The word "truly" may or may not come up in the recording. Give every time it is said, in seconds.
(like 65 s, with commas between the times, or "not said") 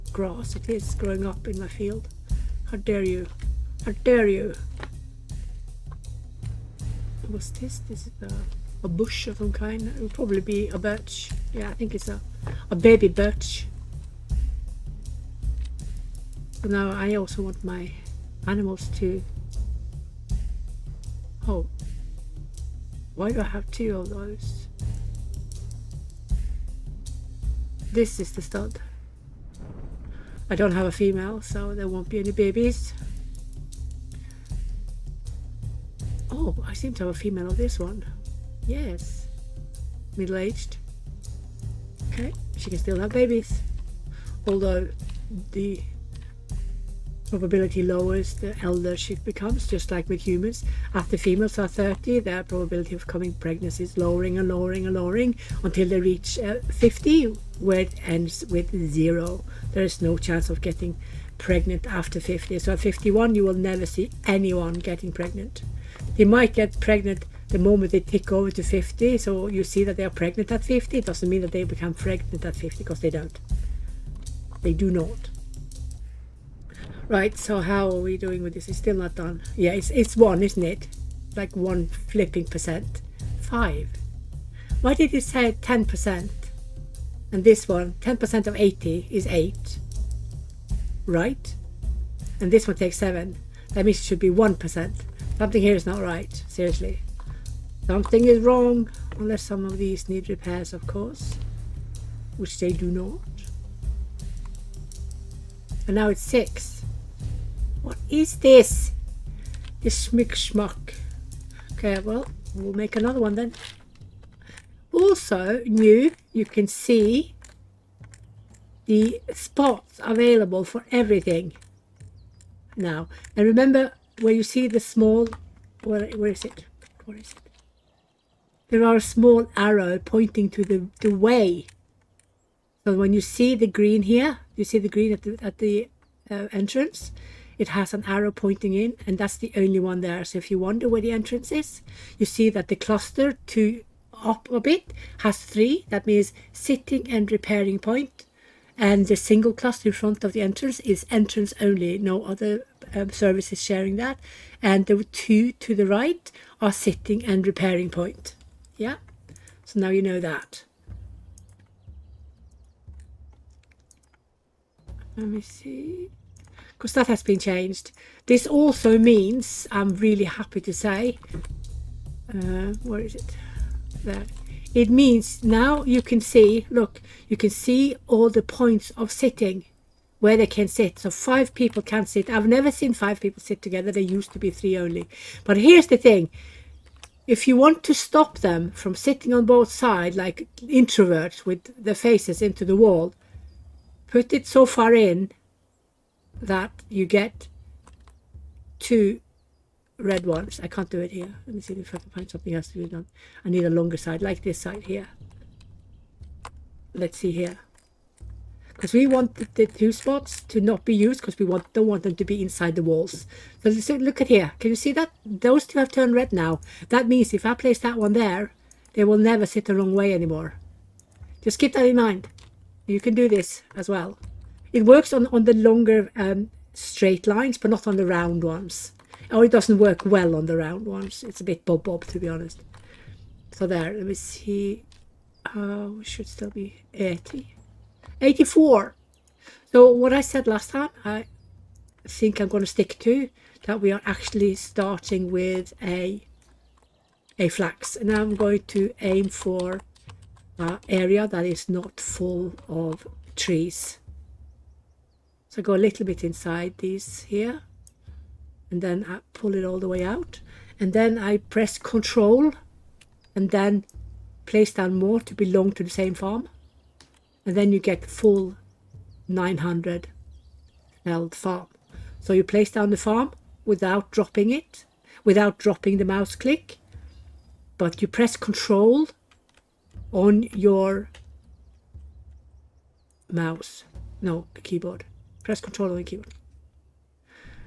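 not said.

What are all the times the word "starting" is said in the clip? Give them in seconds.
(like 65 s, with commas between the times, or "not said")
244 s.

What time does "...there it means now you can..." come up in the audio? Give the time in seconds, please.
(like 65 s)
174 s.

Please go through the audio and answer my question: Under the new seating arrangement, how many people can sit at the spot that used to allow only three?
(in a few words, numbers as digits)
5.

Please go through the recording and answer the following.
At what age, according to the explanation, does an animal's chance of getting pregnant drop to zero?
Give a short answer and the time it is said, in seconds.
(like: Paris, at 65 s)
50, at 56 s.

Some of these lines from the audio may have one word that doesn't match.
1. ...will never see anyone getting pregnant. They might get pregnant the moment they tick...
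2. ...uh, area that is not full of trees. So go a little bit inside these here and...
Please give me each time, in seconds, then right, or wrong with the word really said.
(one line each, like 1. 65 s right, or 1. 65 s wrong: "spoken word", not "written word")
1. 63 s right
2. 250 s right.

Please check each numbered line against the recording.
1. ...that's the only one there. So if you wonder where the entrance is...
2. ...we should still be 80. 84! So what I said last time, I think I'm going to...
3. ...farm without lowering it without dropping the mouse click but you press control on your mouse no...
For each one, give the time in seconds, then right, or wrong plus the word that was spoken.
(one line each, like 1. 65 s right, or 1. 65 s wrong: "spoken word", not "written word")
1. 139 s right
2. 235 s right
3. 272 s wrong: "dropping", not "lowering".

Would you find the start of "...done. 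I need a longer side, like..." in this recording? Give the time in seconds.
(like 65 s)
202 s.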